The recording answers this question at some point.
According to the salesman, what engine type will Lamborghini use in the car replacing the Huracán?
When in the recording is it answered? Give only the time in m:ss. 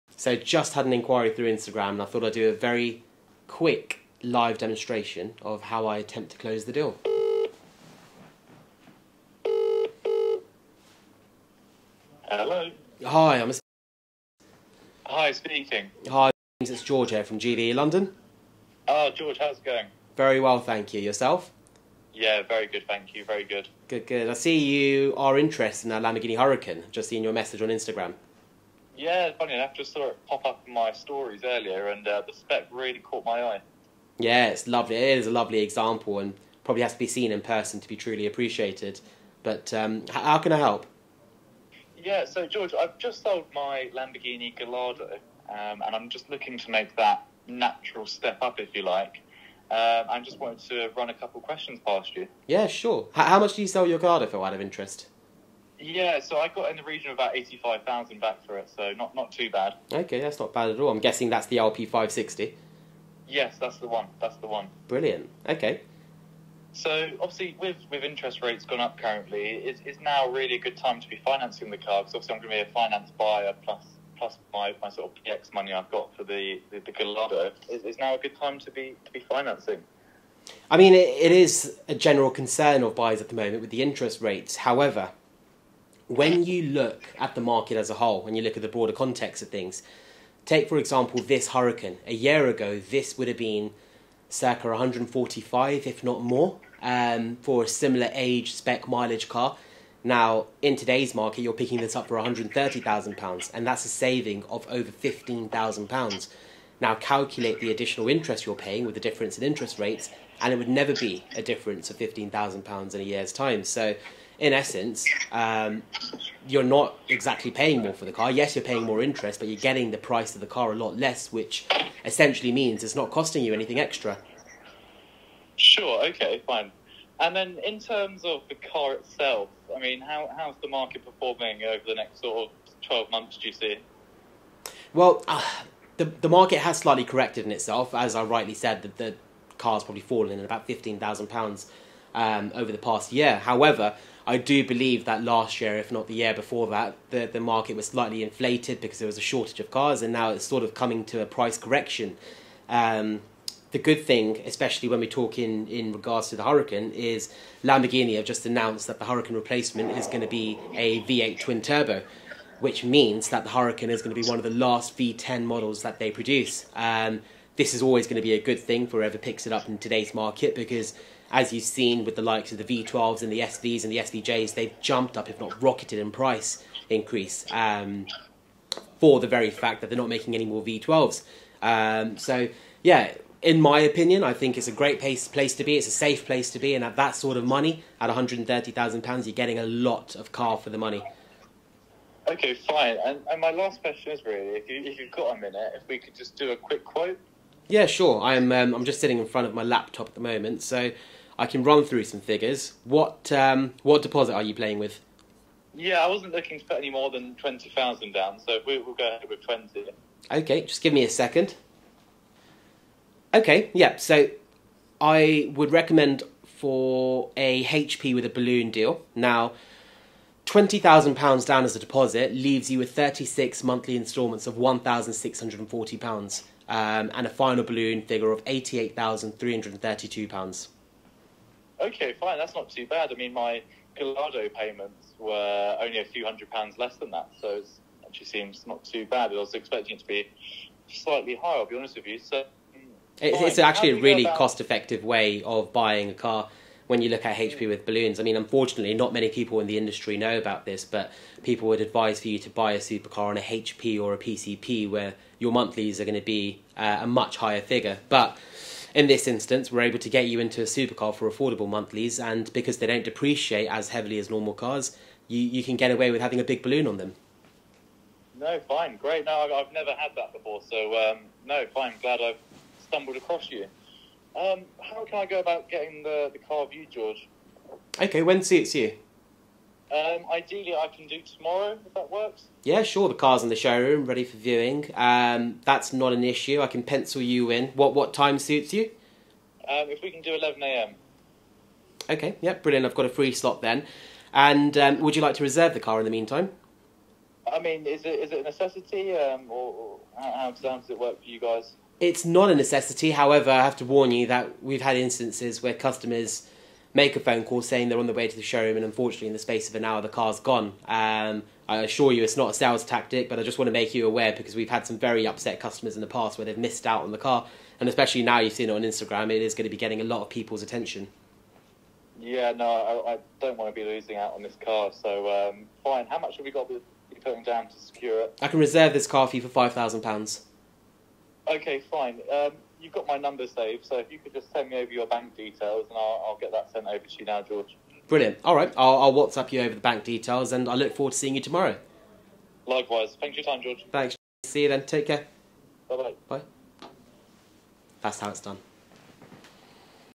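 2:41.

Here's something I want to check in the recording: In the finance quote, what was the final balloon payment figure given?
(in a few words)
£88,332.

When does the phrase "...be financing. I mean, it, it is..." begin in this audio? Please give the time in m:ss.
1:19.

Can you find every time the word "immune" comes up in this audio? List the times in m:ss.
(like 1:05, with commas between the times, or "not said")
not said.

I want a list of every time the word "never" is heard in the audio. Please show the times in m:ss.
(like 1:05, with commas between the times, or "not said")
1:50, 4:29.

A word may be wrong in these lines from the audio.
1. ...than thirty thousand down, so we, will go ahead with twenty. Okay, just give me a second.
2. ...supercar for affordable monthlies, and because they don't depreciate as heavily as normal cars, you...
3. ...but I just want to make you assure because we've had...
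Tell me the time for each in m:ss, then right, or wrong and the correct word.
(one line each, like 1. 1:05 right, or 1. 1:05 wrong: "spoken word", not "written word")
1. 3:27 wrong: "twenty", not "thirty"
2. 4:20 right
3. 5:13 wrong: "aware", not "assure".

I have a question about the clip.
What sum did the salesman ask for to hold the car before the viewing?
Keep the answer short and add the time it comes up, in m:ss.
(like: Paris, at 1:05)
£5,000, at 5:29.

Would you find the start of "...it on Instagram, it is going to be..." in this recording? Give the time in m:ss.
5:18.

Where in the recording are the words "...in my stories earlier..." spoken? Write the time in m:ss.
0:30.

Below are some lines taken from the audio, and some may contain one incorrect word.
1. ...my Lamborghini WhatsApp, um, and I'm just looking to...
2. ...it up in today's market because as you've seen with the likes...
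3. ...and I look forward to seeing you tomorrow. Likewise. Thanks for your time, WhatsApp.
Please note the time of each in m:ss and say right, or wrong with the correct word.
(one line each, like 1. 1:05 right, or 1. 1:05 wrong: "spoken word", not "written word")
1. 0:43 wrong: "Gallardo", not "WhatsApp"
2. 2:49 right
3. 5:40 wrong: "George", not "WhatsApp".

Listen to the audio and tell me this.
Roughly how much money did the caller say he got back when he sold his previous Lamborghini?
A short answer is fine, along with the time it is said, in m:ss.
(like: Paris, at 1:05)
about 85,000, at 0:57.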